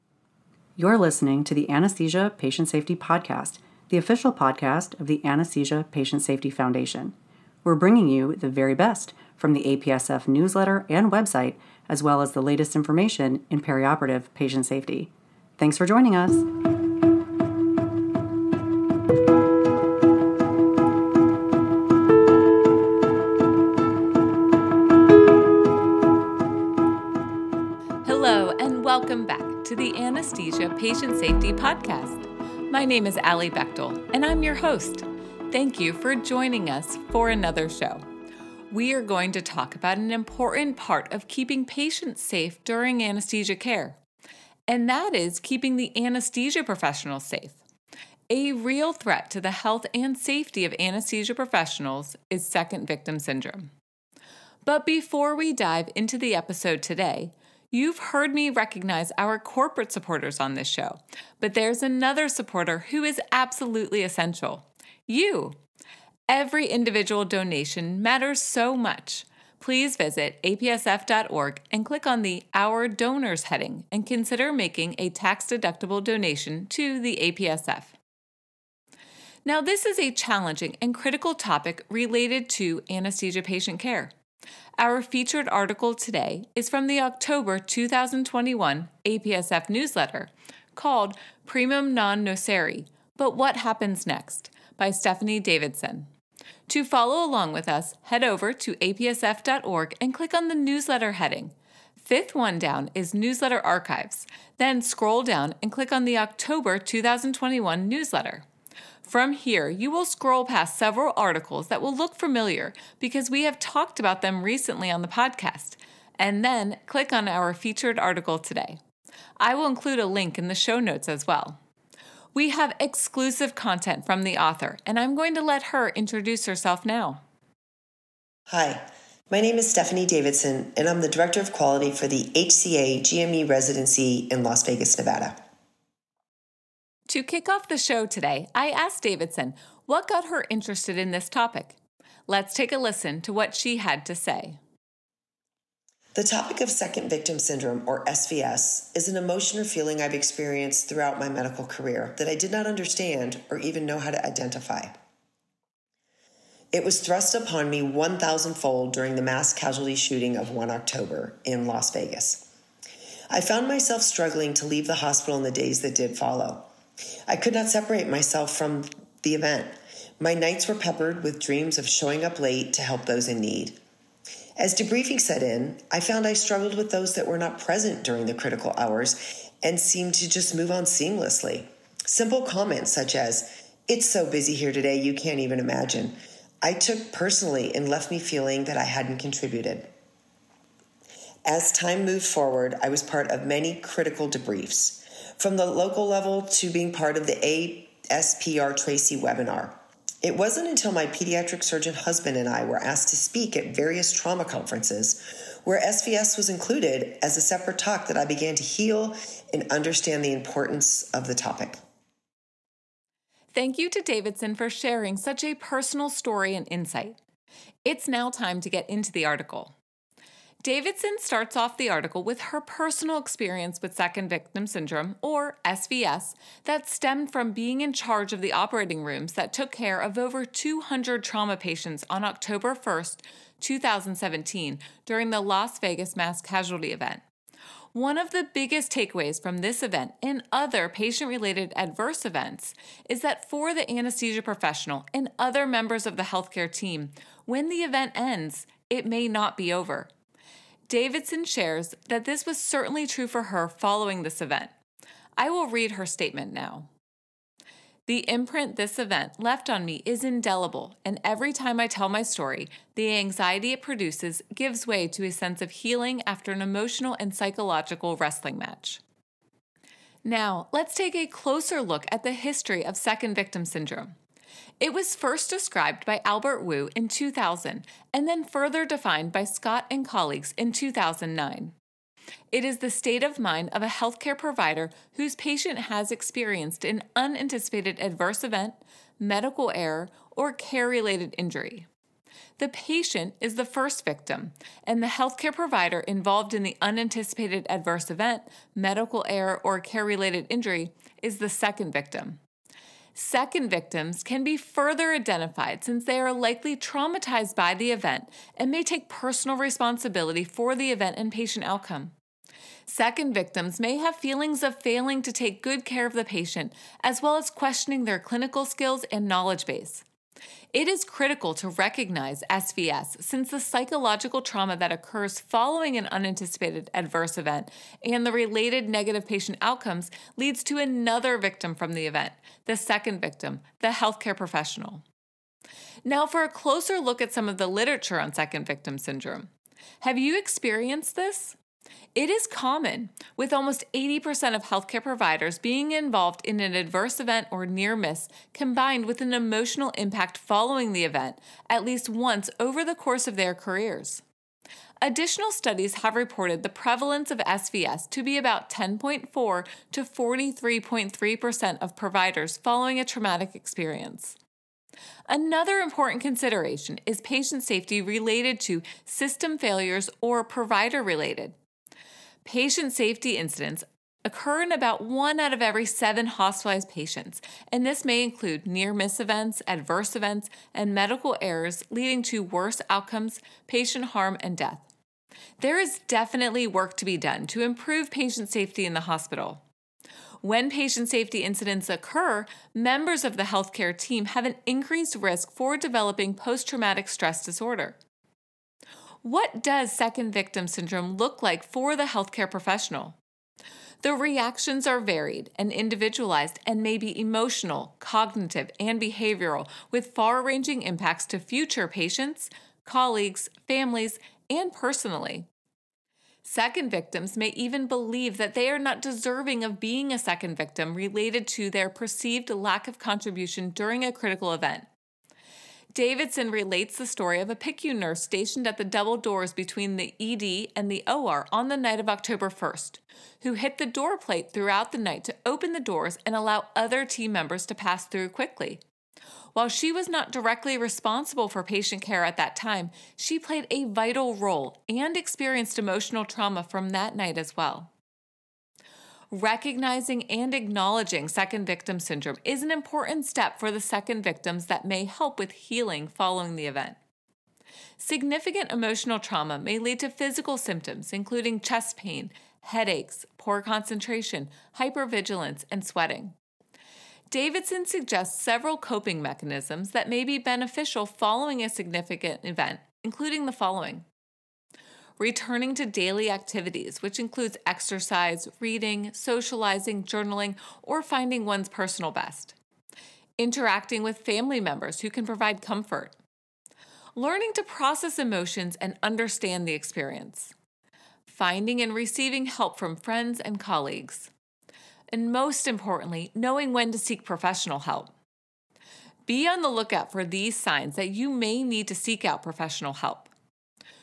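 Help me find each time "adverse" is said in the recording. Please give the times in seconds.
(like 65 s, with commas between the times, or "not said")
241 s, 288 s, 297 s, 326 s, 346 s, 379 s.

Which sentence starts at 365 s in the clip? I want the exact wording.
Another important consideration is patient safety related to system failures or provider related.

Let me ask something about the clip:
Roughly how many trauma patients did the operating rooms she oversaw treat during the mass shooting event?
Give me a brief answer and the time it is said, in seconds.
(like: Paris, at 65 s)
Over 200, at 230 s.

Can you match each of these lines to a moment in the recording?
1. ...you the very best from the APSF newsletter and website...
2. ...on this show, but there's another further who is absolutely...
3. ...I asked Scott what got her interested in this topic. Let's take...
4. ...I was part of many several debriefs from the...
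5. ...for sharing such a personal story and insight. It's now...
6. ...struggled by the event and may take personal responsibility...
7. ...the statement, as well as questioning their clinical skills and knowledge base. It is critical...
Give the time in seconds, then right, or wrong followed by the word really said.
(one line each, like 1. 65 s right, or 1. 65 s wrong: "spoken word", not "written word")
1. 8 s right
2. 60 s wrong: "supporter", not "further"
3. 138 s wrong: "Davidson", not "Scott"
4. 192 s wrong: "critical", not "several"
5. 214 s right
6. 306 s wrong: "traumatized", not "struggled"
7. 316 s wrong: "patient", not "statement".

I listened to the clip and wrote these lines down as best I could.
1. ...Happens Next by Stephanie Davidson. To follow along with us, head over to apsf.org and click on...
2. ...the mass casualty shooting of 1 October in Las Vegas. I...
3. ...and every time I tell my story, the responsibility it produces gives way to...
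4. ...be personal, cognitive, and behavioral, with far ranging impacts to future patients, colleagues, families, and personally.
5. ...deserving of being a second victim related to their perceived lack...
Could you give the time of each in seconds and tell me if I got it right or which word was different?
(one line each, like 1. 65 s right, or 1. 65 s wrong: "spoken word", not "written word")
1. 93 s right
2. 159 s right
3. 261 s wrong: "anxiety", not "responsibility"
4. 406 s wrong: "emotional", not "personal"
5. 419 s right.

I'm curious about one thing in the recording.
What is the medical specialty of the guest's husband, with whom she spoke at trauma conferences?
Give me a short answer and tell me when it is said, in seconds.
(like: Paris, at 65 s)
Pediatric surgeon, at 201 s.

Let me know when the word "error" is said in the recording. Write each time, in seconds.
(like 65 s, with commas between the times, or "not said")
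289 s, 299 s, 381 s.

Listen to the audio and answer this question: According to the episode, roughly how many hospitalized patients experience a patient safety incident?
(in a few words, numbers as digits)
1 in 7.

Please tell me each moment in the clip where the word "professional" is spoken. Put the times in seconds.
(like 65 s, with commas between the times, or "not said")
46 s, 51 s, 244 s, 334 s, 402 s, 497 s, 502 s.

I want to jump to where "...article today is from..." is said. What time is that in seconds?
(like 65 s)
85 s.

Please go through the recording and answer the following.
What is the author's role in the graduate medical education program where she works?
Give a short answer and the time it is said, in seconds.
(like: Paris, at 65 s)
Director of Quality, at 131 s.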